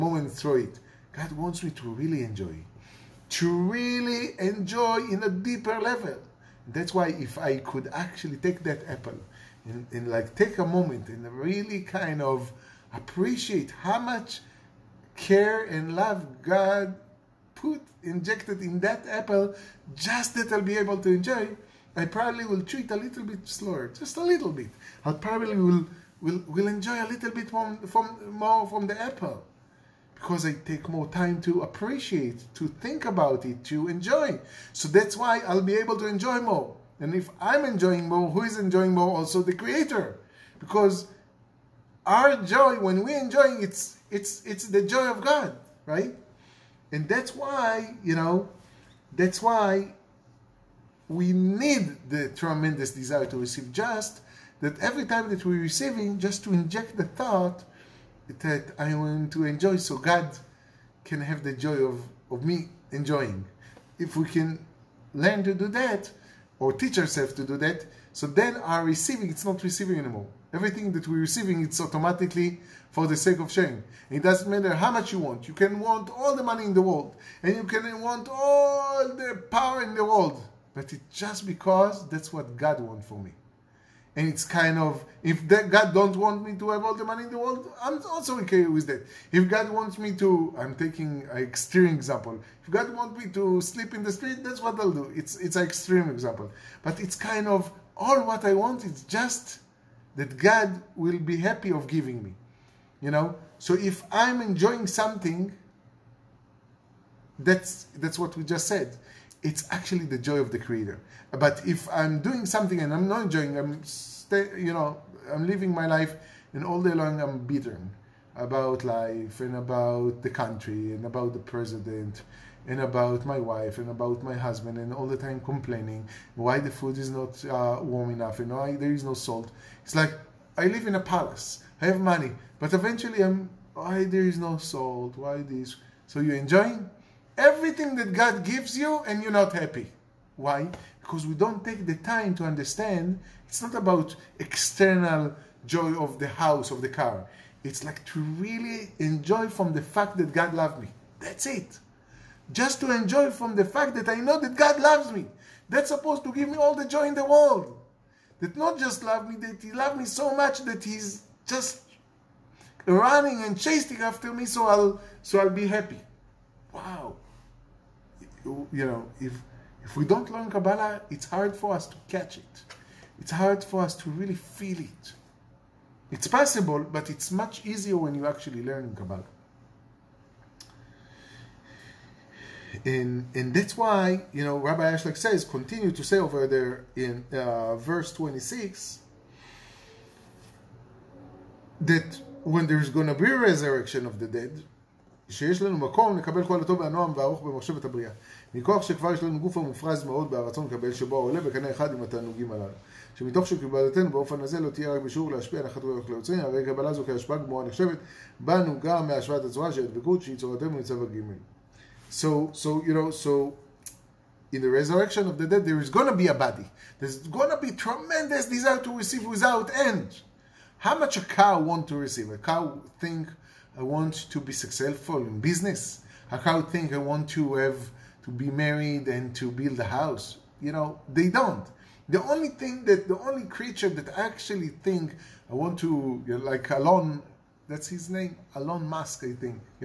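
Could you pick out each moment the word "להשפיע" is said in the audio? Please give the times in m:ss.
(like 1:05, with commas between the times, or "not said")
3:25.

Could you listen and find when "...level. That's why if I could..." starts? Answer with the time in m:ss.
0:05.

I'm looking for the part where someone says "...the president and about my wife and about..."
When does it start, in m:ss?
2:01.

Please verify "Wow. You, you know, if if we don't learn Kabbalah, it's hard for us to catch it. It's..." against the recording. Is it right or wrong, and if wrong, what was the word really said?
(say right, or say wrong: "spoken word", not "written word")
right.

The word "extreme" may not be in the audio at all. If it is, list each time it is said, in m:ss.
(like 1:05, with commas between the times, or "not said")
1:31, 1:35.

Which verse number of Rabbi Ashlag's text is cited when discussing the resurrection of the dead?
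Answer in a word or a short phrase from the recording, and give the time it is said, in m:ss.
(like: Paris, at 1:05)
26, at 3:08.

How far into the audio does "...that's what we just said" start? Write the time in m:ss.
1:47.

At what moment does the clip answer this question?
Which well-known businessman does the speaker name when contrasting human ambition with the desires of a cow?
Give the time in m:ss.
3:58.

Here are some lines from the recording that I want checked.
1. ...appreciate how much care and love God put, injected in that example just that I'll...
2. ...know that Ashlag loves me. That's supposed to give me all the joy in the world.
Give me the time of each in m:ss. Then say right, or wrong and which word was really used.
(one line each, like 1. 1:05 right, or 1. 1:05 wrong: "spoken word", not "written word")
1. 0:12 wrong: "apple", not "example"
2. 2:34 wrong: "God", not "Ashlag".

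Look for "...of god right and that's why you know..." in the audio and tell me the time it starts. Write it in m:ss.
0:45.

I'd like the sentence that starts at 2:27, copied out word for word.
It's like to really enjoy from the fact that God loved me.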